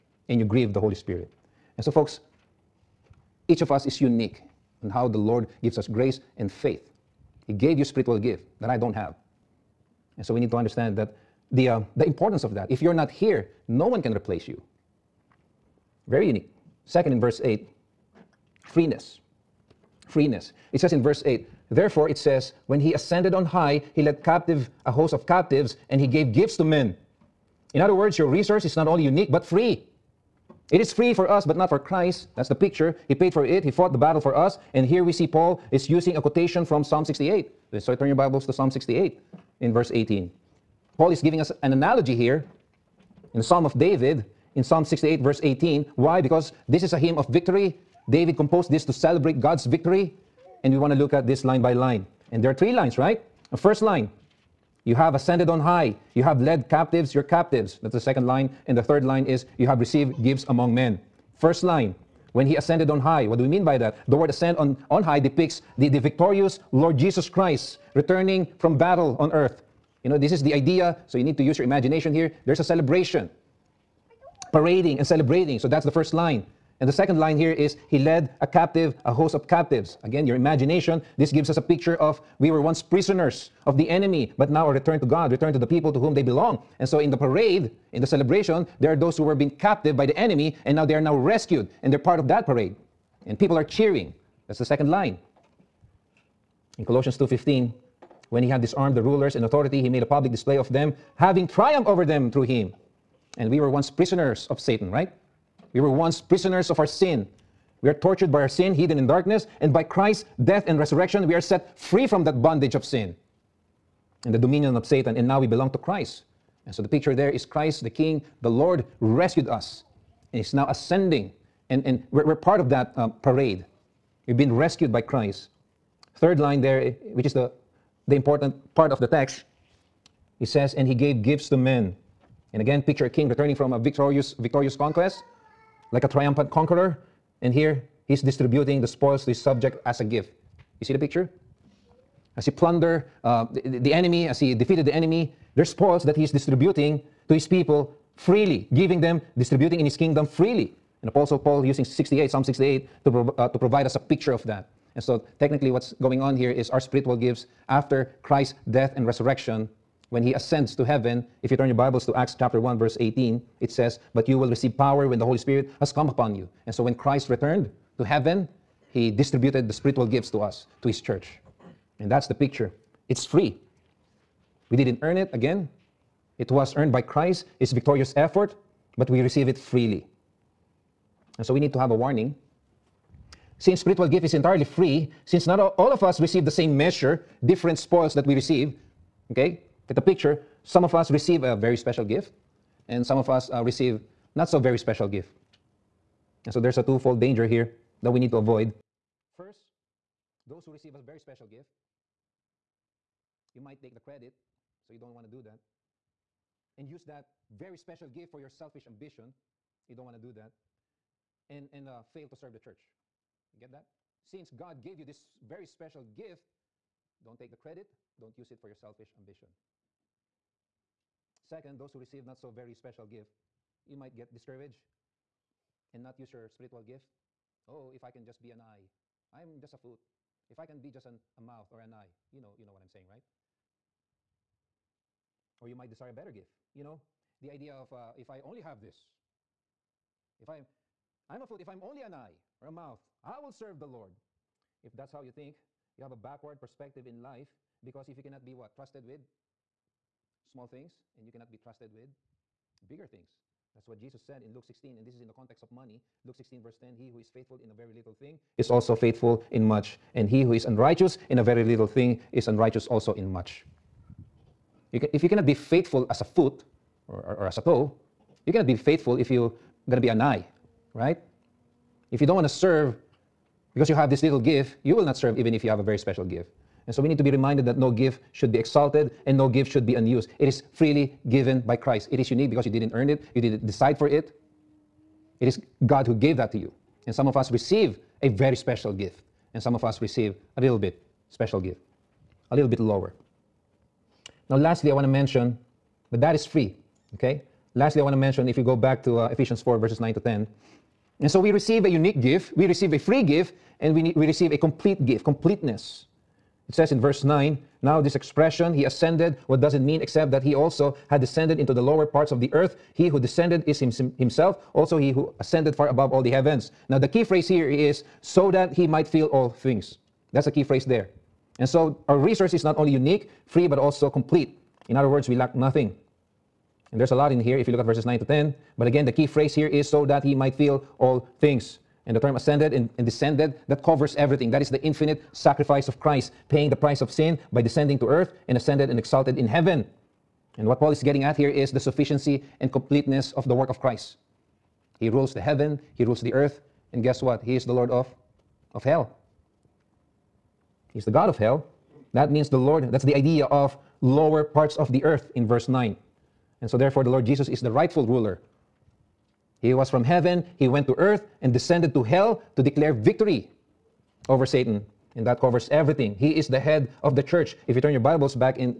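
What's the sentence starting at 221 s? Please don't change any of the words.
Second, those who receive not so very special gift, you might get discouraged and not use your spiritual gift.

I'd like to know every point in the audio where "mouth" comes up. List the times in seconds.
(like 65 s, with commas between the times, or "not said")
231 s, 242 s.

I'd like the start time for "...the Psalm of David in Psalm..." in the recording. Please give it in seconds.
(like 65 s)
43 s.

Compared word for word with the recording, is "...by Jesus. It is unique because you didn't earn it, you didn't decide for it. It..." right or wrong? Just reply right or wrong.
wrong.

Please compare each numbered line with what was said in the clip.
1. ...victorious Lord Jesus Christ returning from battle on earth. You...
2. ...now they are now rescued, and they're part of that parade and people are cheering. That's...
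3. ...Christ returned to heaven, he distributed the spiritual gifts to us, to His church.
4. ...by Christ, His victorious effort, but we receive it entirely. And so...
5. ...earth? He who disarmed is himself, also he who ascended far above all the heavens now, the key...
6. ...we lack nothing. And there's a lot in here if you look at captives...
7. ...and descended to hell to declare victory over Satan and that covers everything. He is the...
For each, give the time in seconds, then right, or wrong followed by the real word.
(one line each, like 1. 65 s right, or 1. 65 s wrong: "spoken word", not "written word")
1. 65 s right
2. 90 s right
3. 166 s right
4. 176 s wrong: "freely", not "entirely"
5. 312 s wrong: "descended", not "disarmed"
6. 325 s wrong: "verses", not "captives"
7. 361 s right.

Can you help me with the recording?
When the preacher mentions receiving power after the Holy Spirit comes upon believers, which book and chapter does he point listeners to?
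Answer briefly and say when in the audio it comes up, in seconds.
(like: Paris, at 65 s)
Acts chapter 1, at 162 s.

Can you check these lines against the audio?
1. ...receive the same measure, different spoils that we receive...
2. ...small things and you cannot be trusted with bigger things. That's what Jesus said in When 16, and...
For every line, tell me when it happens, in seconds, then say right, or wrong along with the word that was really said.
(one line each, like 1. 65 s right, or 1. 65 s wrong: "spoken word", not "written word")
1. 186 s right
2. 250 s wrong: "Luke", not "When".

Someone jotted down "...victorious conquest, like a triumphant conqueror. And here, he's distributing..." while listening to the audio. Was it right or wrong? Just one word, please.
right.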